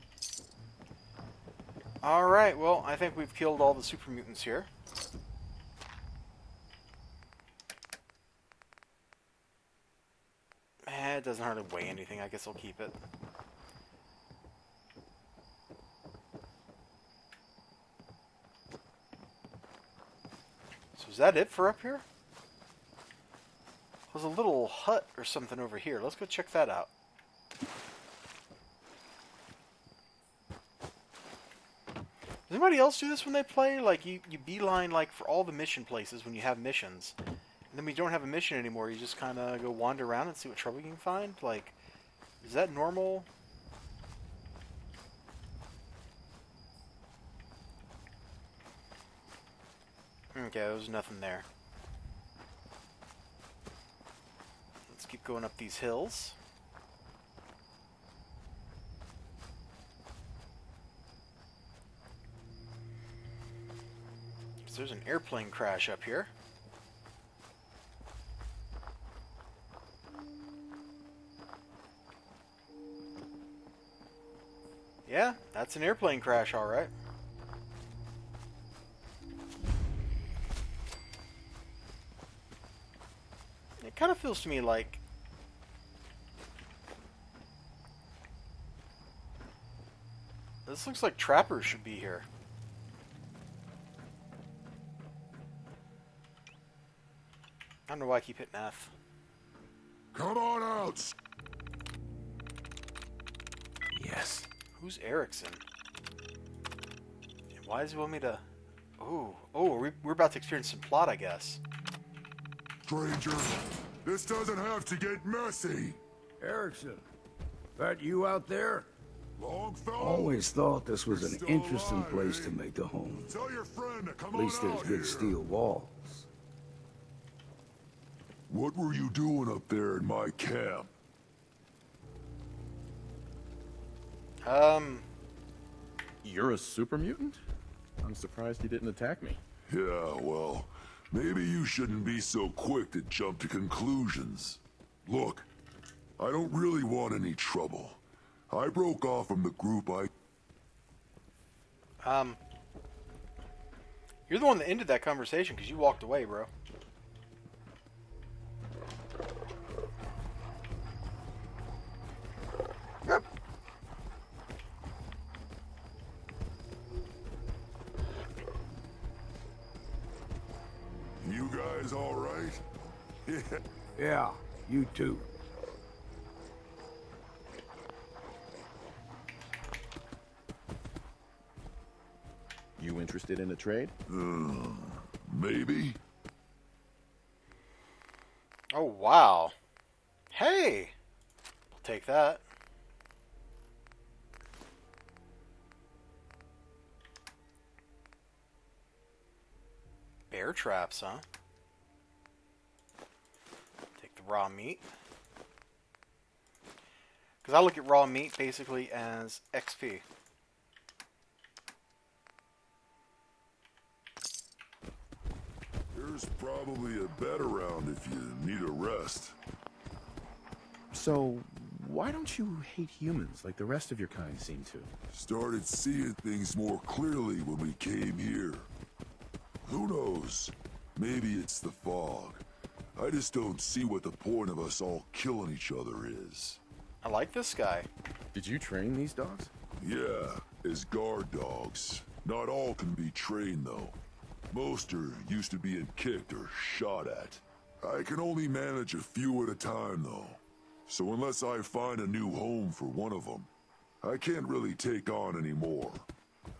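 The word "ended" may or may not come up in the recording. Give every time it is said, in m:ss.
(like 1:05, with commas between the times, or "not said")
2:34.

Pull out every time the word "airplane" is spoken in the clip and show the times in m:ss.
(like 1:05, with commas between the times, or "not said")
1:05, 1:15.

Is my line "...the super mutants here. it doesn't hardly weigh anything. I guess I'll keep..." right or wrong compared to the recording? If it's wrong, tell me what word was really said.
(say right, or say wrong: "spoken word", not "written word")
right.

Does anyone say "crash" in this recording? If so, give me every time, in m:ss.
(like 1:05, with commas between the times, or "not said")
1:05, 1:16.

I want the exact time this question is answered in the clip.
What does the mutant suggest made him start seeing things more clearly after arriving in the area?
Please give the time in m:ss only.
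3:51.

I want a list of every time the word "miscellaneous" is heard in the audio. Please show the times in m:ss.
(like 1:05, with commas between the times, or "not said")
not said.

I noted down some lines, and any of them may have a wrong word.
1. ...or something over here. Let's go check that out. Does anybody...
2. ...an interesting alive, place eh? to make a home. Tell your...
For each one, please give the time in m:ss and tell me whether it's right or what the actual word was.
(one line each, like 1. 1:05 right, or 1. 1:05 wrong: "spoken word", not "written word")
1. 0:25 right
2. 2:01 right.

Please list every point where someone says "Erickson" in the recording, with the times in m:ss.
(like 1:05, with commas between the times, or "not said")
1:45, 1:56.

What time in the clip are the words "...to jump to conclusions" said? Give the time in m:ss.
2:22.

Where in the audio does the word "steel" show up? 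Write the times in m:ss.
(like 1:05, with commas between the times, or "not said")
2:05.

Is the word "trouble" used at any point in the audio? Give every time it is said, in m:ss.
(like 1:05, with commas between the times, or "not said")
0:40, 2:27.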